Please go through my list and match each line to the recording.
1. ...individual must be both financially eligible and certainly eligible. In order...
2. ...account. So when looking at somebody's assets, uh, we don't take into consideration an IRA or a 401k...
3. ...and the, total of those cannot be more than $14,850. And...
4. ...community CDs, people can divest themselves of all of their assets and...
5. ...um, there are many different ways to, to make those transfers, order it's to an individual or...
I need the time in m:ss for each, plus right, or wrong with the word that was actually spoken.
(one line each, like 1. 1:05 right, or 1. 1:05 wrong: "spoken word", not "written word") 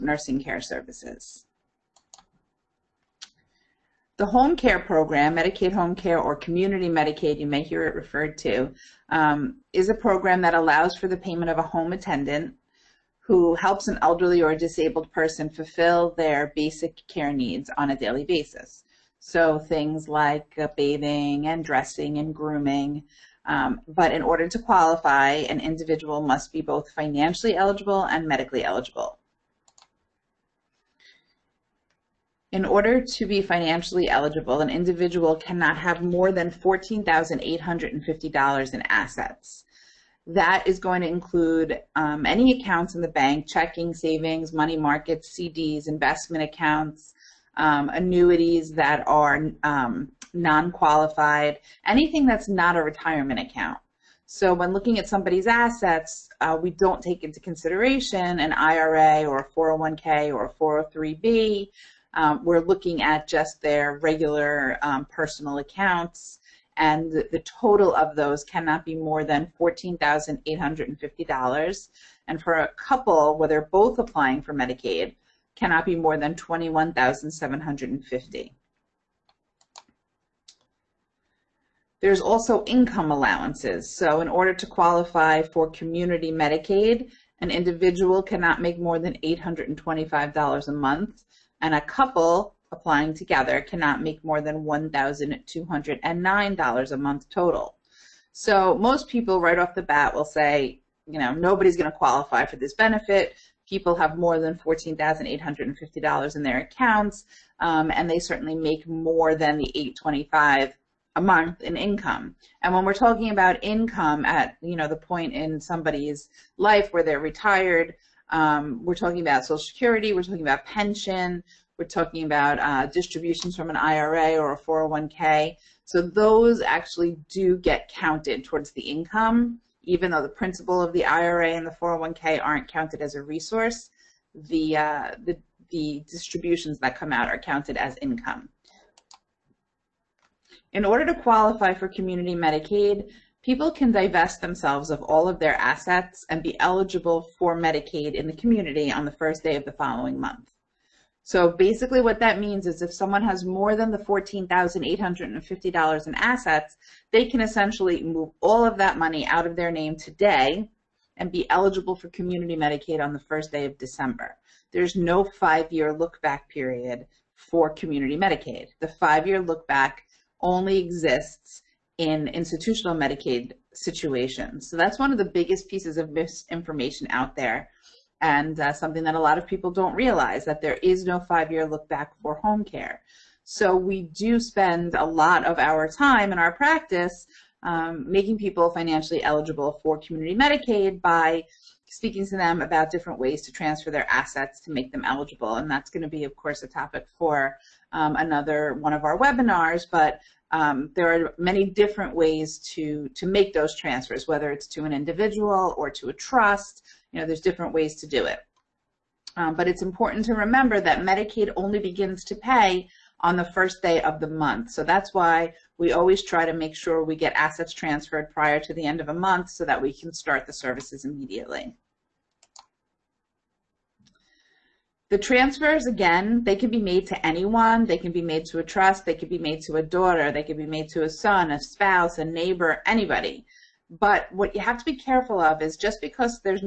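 1. 0:25 wrong: "medically", not "certainly"
2. 0:53 right
3. 1:06 right
4. 2:21 wrong: "Medicaid", not "CDs"
5. 3:20 wrong: "whether", not "order".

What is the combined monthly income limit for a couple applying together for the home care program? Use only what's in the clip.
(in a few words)
$1,209.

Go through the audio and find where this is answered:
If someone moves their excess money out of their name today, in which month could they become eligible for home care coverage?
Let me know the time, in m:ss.
2:43.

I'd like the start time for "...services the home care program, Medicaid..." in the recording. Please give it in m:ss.
0:00.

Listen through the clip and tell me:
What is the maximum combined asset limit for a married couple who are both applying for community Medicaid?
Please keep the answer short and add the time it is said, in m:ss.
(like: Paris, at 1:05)
$21,750, at 1:16.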